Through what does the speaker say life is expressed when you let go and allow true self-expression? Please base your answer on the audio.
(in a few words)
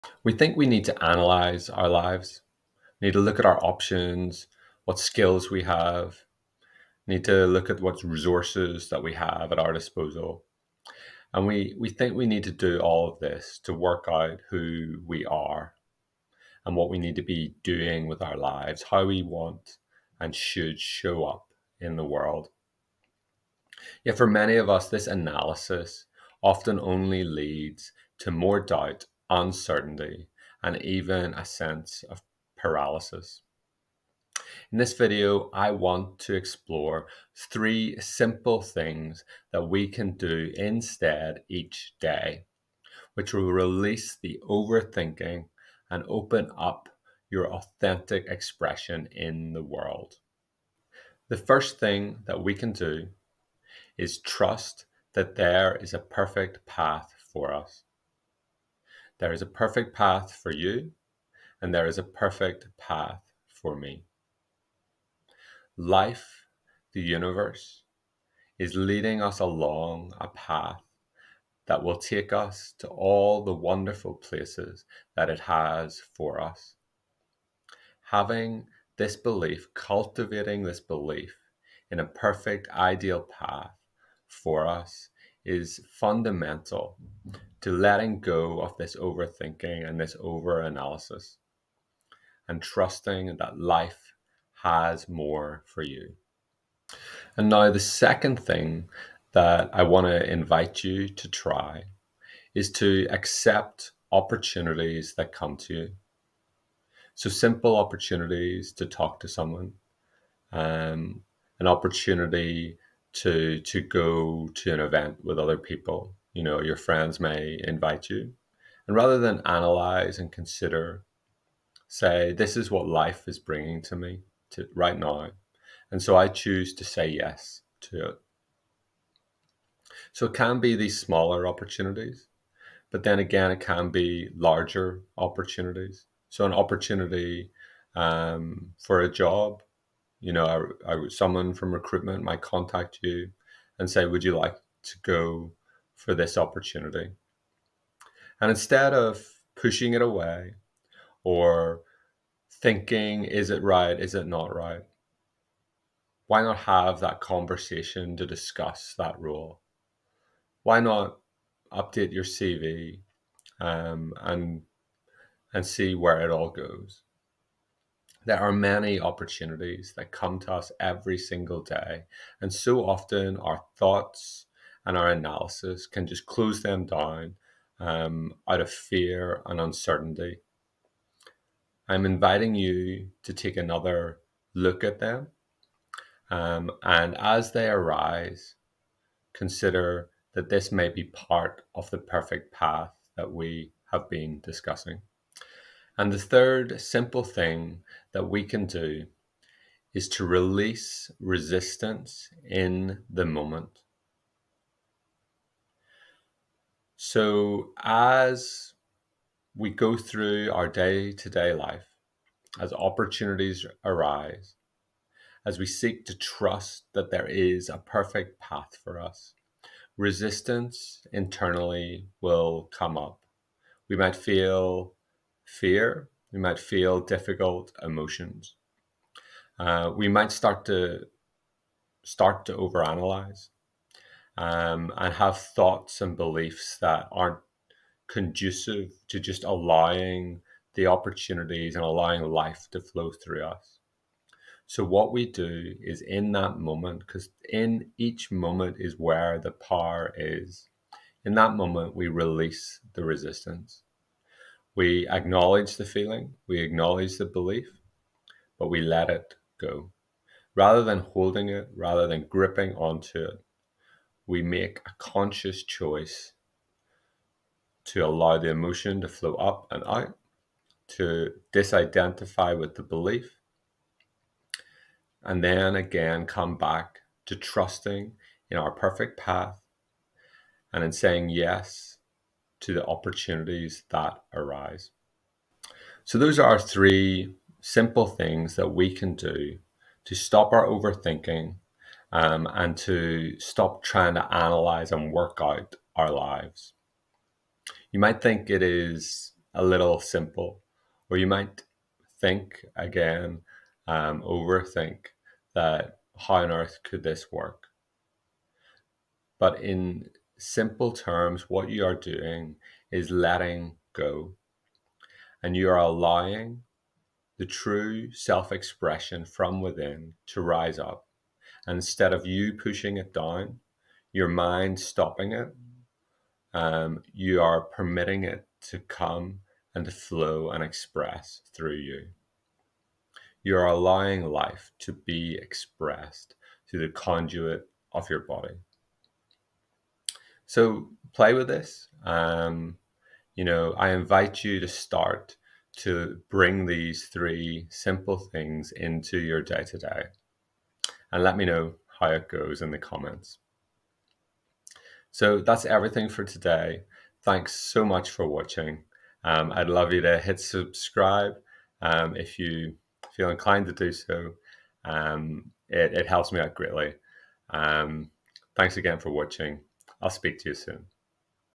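The conduit of your body.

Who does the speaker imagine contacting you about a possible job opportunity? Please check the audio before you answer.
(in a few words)
Someone from recruitment.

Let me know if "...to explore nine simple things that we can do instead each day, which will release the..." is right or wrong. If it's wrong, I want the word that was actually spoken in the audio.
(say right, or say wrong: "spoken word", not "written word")
wrong: "three", not "nine".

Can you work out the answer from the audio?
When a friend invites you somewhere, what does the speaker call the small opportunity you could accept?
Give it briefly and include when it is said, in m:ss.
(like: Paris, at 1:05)
An event, at 1:54.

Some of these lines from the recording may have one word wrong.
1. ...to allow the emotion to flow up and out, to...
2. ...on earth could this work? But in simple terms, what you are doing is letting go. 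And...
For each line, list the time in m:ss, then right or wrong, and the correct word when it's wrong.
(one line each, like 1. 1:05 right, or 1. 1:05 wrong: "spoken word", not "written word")
1. 4:27 right
2. 5:06 right.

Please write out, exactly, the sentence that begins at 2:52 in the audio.
And so often our thoughts and our analysis can just close them down um, out of fear and uncertainty.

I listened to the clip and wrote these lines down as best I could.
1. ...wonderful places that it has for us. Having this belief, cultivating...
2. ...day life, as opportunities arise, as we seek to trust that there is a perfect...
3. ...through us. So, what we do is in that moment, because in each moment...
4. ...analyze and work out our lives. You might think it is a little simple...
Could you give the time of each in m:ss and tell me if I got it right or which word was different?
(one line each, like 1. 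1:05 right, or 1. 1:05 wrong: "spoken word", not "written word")
1. 1:13 right
2. 3:31 right
3. 4:03 right
4. 4:54 right.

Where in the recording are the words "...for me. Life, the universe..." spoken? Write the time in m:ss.
1:03.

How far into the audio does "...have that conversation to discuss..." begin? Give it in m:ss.
2:36.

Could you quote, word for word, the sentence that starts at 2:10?
So it can be these smaller opportunities, but then again, it can be larger opportunities.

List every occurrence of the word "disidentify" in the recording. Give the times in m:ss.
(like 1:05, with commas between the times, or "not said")
4:31.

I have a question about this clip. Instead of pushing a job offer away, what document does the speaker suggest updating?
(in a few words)
CV.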